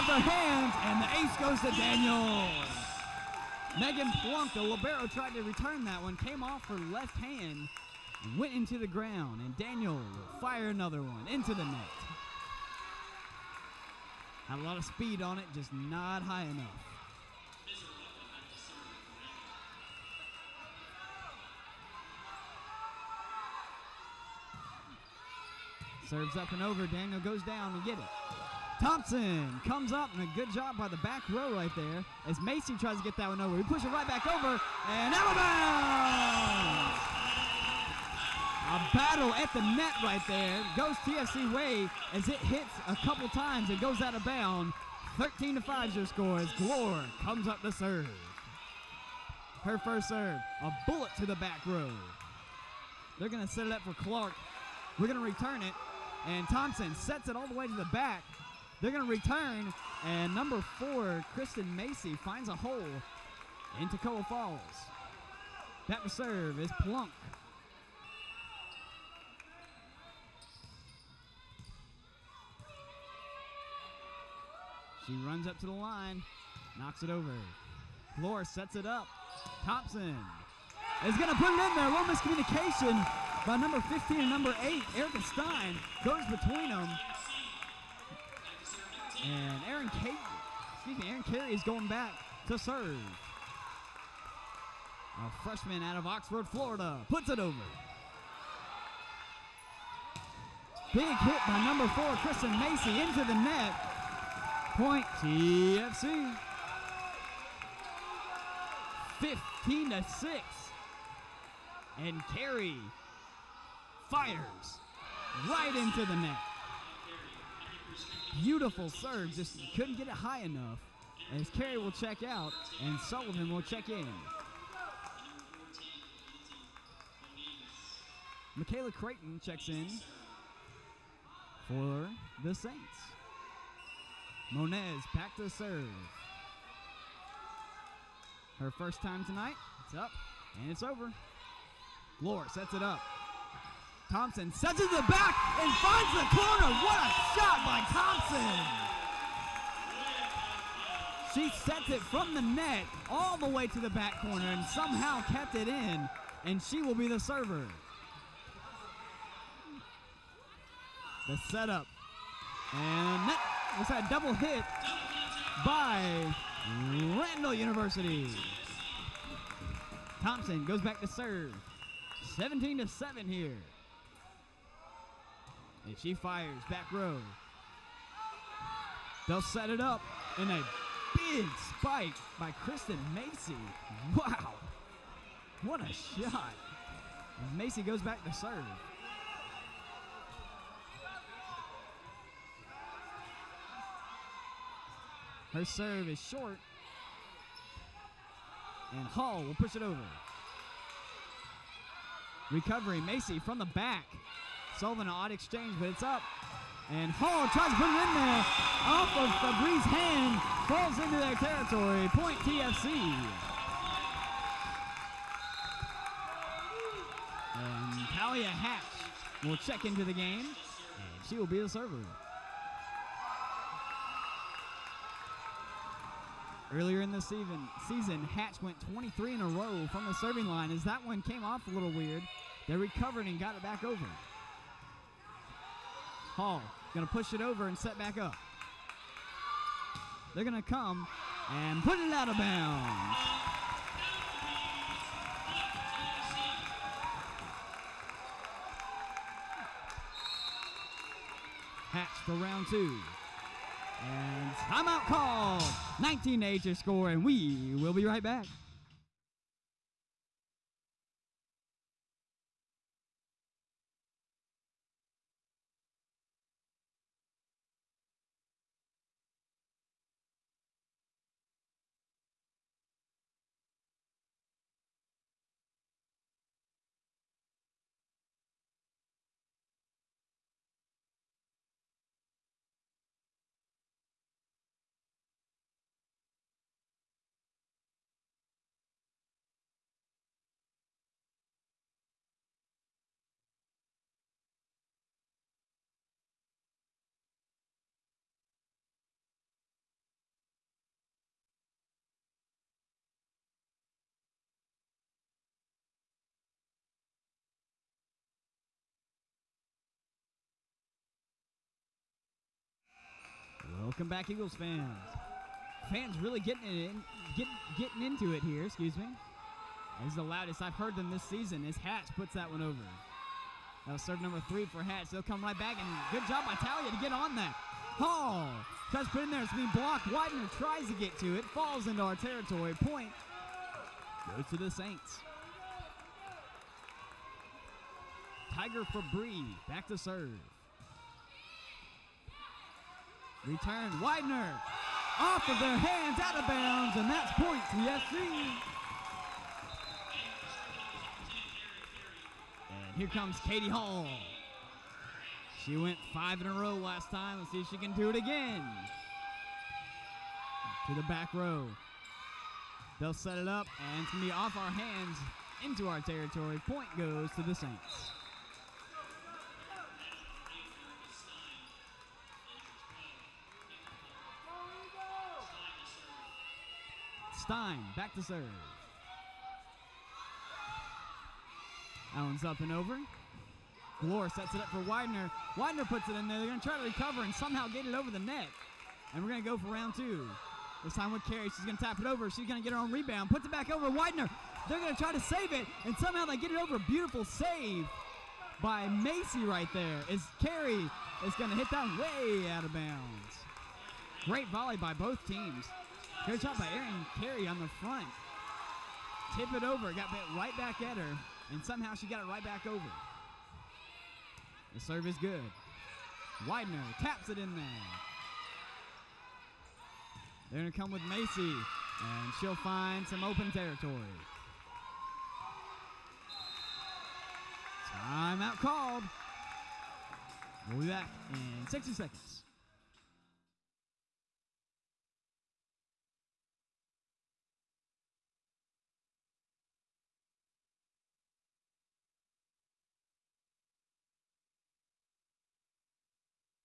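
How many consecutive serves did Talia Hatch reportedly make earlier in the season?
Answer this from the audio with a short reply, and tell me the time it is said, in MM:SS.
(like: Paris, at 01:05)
23, at 03:48.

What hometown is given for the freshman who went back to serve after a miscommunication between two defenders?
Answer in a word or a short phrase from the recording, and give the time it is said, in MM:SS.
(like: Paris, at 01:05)
Oxford, Florida, at 01:36.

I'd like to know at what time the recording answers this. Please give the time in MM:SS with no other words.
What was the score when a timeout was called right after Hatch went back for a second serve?
04:16.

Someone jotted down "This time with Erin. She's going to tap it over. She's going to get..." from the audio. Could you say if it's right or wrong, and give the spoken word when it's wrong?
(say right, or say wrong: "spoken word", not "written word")
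wrong: "Carey", not "Erin".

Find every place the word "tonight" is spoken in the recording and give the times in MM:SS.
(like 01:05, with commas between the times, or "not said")
02:19.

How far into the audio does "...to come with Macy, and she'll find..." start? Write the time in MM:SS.
07:00.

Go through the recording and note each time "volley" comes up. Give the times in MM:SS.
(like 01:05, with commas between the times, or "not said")
06:44.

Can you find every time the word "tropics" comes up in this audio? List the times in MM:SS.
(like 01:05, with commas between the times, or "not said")
not said.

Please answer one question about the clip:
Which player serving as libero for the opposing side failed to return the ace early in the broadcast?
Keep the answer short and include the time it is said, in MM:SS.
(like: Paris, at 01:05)
Megan Plunk, at 00:03.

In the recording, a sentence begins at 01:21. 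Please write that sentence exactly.
A little miscommunication by number 15 and number 8.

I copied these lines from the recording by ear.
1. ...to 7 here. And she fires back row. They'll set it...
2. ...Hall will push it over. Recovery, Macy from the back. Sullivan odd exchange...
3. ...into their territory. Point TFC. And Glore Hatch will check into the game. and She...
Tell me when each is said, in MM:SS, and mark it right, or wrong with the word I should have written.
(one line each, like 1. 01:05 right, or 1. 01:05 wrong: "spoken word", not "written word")
1. 02:52 right
2. 03:19 right
3. 03:30 wrong: "Talia", not "Glore".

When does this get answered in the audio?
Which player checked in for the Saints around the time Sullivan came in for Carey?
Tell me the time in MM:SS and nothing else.
02:08.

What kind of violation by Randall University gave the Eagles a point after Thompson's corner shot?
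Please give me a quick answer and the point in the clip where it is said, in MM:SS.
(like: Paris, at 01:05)
double hit, at 02:44.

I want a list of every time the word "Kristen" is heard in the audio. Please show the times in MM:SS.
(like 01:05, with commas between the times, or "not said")
01:01, 01:42, 03:02.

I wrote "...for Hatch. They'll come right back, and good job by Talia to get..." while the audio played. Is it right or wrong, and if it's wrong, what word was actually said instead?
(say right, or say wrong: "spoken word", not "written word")
right.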